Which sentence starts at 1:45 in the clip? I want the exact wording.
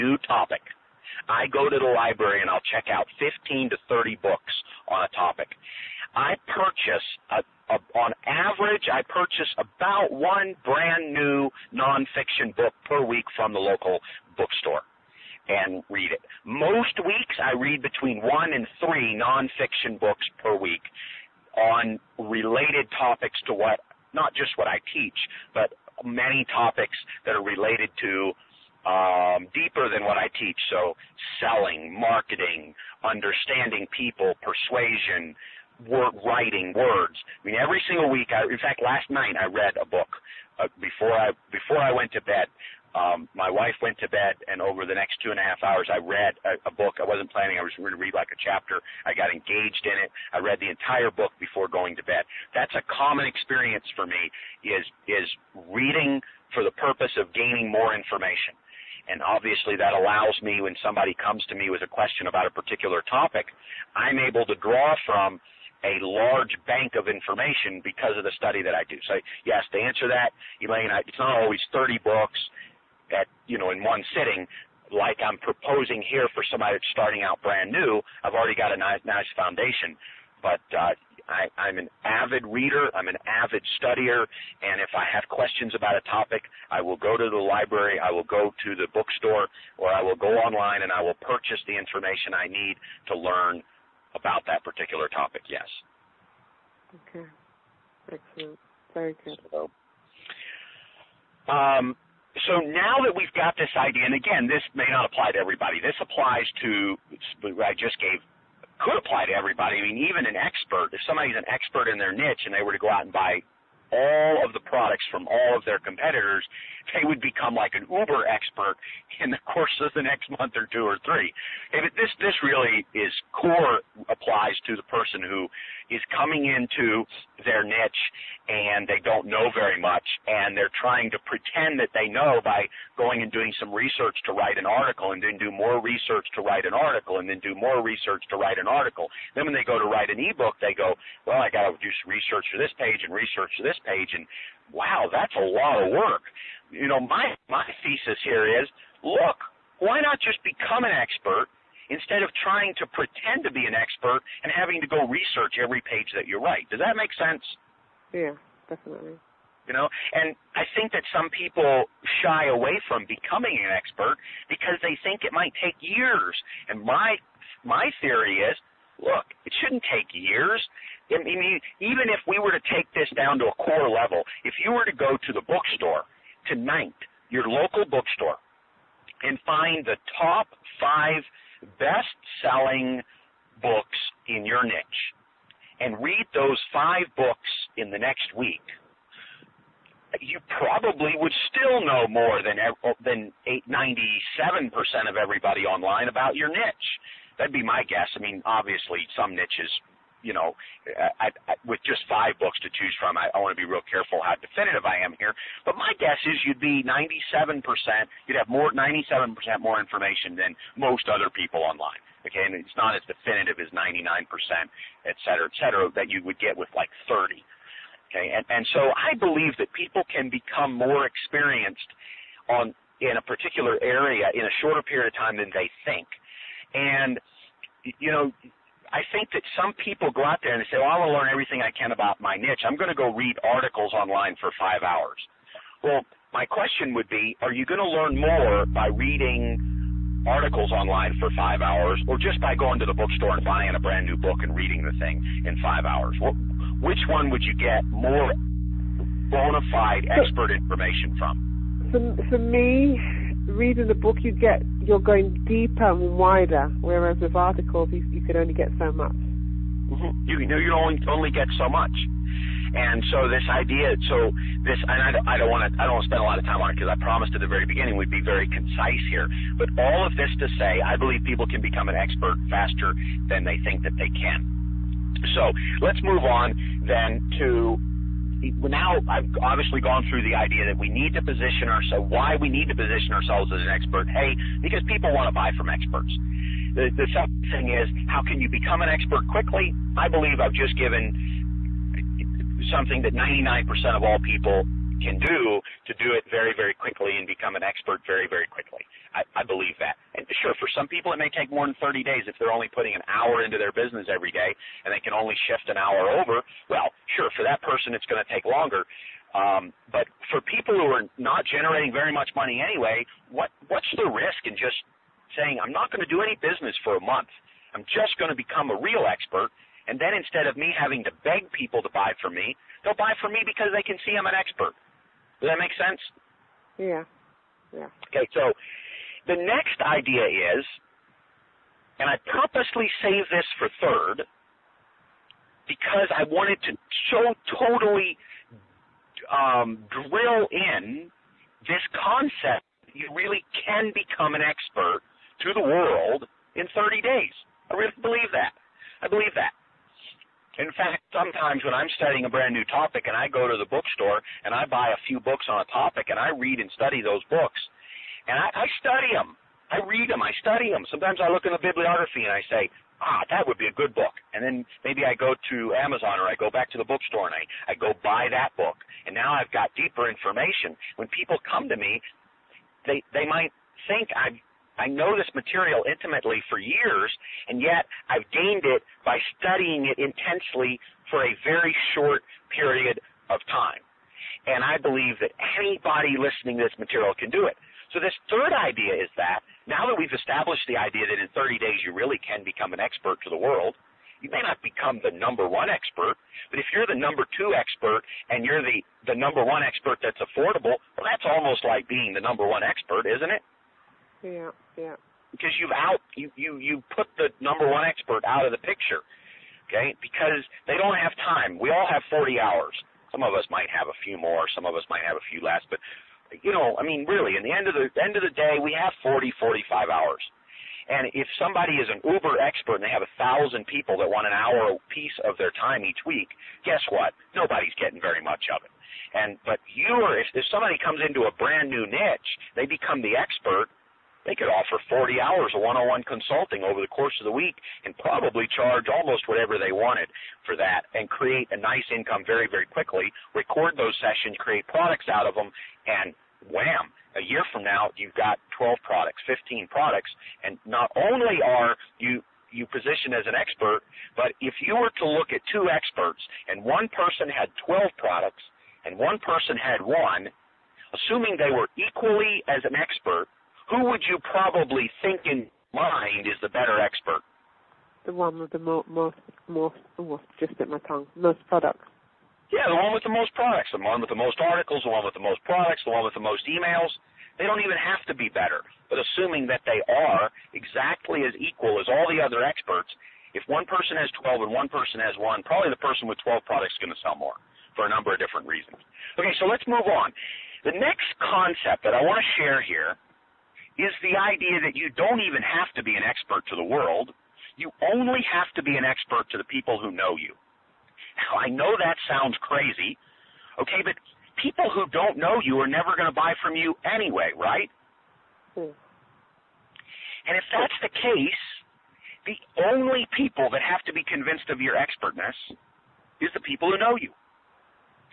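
This applies to I just gave could apply to everybody.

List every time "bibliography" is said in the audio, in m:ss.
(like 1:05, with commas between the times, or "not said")
6:01.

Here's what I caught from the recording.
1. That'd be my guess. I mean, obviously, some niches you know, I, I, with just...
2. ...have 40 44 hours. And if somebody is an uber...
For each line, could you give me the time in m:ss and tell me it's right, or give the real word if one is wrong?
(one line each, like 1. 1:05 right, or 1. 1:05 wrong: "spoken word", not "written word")
1. 3:17 right
2. 6:58 wrong: "45", not "44".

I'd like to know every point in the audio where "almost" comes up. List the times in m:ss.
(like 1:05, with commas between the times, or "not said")
6:41, 7:18.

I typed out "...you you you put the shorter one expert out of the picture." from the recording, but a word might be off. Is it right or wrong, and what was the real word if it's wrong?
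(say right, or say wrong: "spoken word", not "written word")
wrong: "number", not "shorter".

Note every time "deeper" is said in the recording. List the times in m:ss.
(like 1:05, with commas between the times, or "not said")
0:29, 4:15, 6:09.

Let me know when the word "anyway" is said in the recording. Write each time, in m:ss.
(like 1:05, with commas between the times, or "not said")
5:12, 8:26.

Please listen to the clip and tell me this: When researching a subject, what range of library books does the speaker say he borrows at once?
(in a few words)
15 to 30.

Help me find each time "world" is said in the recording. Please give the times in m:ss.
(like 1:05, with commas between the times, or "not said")
5:45, 6:33, 8:16.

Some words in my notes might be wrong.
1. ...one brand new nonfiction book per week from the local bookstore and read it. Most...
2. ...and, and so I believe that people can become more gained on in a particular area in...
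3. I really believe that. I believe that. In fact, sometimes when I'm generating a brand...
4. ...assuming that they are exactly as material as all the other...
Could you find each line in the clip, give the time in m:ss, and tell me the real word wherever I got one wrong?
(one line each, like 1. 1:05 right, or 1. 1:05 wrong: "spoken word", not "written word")
1. 0:10 right
2. 3:38 wrong: "experienced", not "gained"
3. 5:47 wrong: "studying", not "generating"
4. 7:58 wrong: "equal", not "material".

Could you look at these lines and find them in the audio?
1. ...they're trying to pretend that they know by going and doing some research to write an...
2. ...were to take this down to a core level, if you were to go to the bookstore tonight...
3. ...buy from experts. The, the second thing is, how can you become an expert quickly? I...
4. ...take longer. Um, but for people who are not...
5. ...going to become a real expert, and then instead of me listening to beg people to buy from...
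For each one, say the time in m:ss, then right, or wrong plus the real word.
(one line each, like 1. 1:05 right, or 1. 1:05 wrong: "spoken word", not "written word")
1. 2:10 right
2. 2:52 right
3. 4:45 right
4. 5:08 right
5. 5:18 wrong: "having", not "listening".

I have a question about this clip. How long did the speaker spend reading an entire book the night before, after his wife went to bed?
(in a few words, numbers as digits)
2.5 hours.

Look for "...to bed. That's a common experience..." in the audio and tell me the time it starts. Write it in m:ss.
0:52.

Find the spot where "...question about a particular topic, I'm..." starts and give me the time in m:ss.
1:01.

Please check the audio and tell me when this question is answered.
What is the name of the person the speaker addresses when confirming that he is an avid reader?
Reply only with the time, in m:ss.
1:10.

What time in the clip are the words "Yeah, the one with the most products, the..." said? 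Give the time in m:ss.
7:52.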